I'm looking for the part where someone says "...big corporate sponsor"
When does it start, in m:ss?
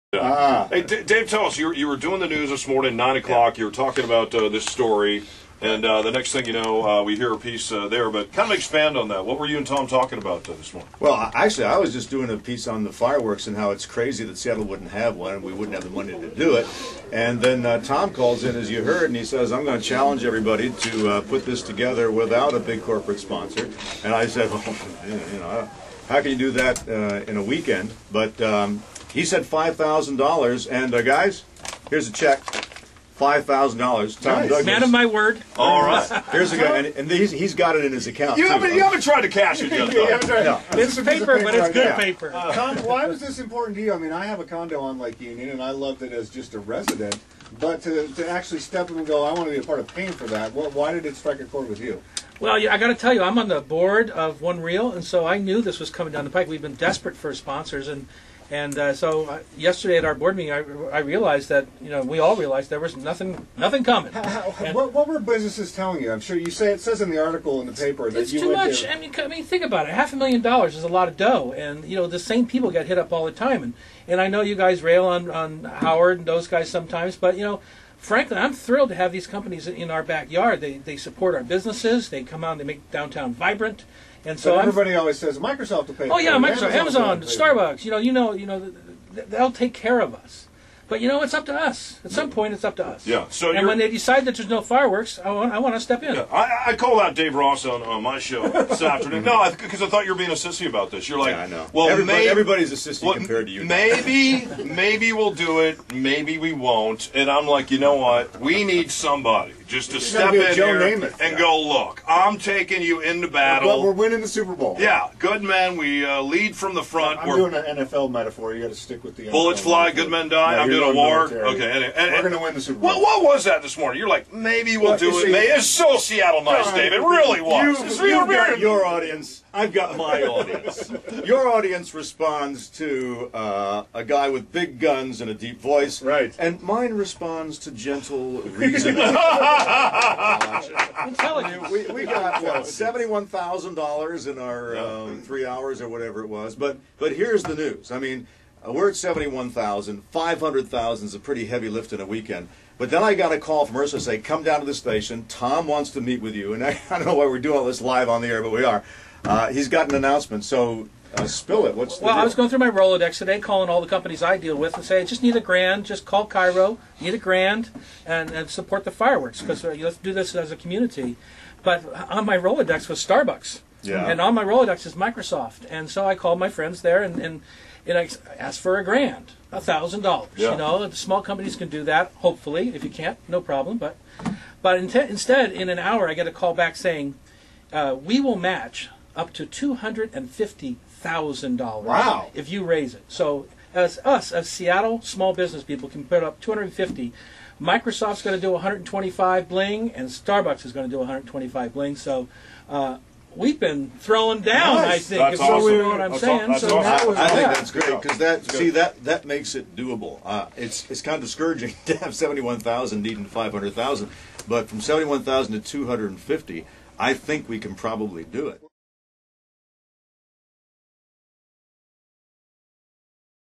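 0:22.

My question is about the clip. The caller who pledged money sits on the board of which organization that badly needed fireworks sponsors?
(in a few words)
One Reel.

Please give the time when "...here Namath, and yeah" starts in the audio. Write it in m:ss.
1:50.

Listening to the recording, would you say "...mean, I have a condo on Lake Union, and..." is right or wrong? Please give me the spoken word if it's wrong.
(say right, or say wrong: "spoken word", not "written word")
right.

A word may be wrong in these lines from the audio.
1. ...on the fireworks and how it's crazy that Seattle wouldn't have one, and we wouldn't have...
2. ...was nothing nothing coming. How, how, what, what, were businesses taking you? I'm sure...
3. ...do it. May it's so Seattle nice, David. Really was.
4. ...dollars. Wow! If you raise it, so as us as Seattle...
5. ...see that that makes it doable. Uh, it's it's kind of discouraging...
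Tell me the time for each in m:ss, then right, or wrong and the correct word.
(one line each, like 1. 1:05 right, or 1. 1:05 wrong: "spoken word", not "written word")
1. 0:12 right
2. 1:02 wrong: "telling", not "taking"
3. 2:04 right
4. 3:11 right
5. 3:28 right.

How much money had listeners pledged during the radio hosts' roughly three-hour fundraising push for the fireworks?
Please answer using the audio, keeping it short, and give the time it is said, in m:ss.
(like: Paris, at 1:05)
$71,000, at 2:22.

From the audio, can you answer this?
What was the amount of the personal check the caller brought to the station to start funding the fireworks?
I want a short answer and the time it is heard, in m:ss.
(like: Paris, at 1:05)
$5,000, at 0:33.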